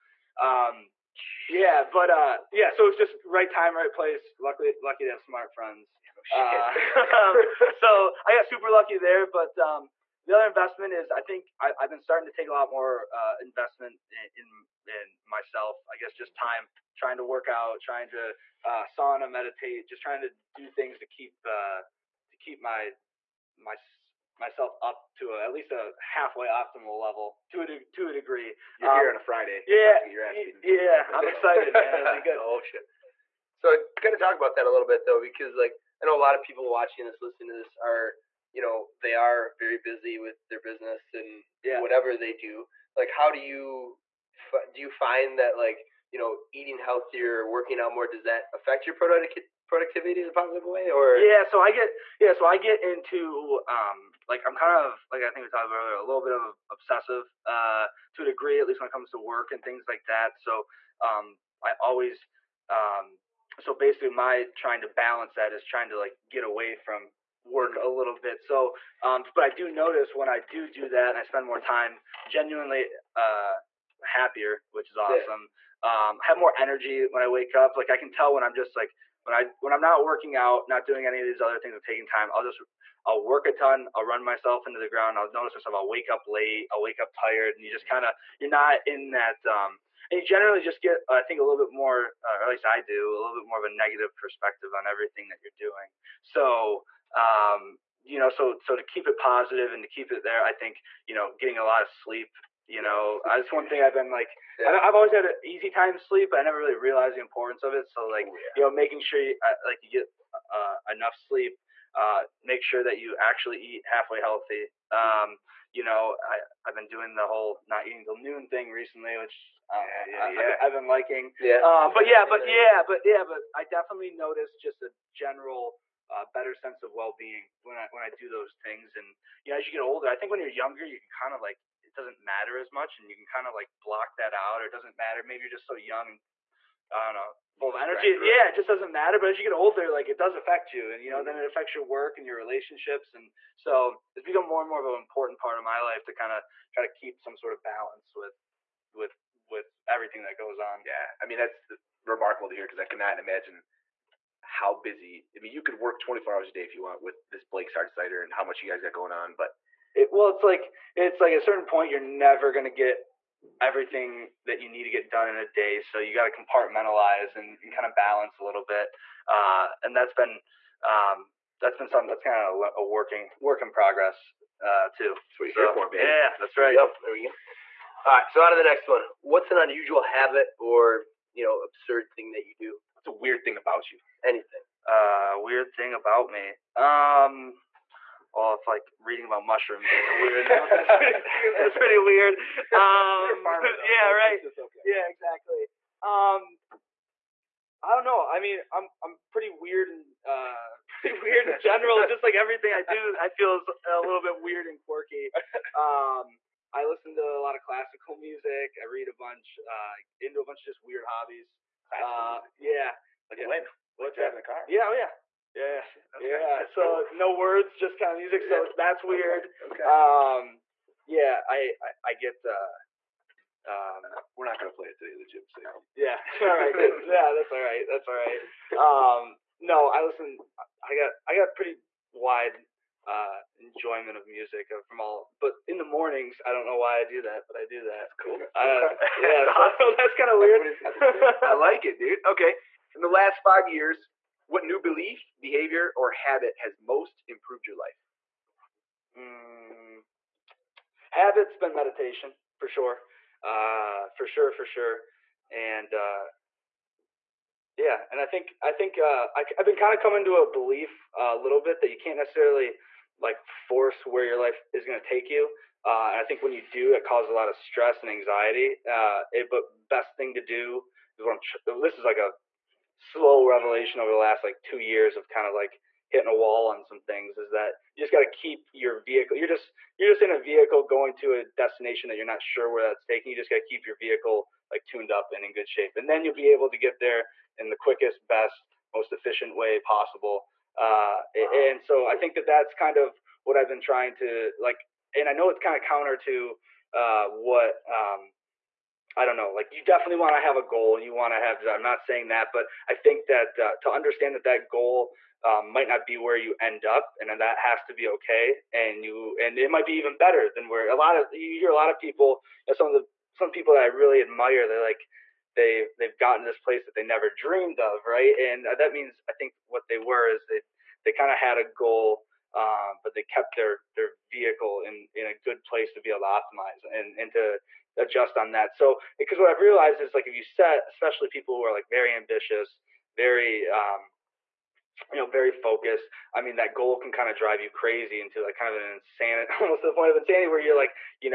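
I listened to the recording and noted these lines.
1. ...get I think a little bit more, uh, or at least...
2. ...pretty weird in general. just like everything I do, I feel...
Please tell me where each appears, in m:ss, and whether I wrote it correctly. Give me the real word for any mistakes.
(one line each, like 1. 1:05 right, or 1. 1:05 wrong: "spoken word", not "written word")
1. 1:30 right
2. 3:21 right.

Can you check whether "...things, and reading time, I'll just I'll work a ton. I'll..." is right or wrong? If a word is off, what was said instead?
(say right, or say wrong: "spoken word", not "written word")
wrong: "taking", not "reading".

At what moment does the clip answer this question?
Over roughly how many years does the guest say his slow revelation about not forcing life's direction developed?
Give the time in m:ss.
4:34.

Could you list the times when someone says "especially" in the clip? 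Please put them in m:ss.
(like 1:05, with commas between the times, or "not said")
5:30.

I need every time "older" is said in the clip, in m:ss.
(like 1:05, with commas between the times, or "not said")
2:09, 2:19.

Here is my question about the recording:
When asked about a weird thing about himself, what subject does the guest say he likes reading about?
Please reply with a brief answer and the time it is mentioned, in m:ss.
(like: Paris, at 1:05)
mushrooms, at 3:09.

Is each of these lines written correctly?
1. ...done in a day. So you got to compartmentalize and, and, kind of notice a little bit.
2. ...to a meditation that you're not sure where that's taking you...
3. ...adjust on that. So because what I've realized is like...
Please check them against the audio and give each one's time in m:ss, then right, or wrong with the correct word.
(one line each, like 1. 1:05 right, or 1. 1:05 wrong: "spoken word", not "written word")
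1. 2:45 wrong: "balance", not "notice"
2. 4:41 wrong: "destination", not "meditation"
3. 5:27 right.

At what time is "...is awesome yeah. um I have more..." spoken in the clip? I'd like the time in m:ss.
1:14.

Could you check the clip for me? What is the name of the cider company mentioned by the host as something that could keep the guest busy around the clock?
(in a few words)
Blake's Hard Cider.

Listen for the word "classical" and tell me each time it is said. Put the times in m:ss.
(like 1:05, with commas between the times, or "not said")
3:27, 3:31.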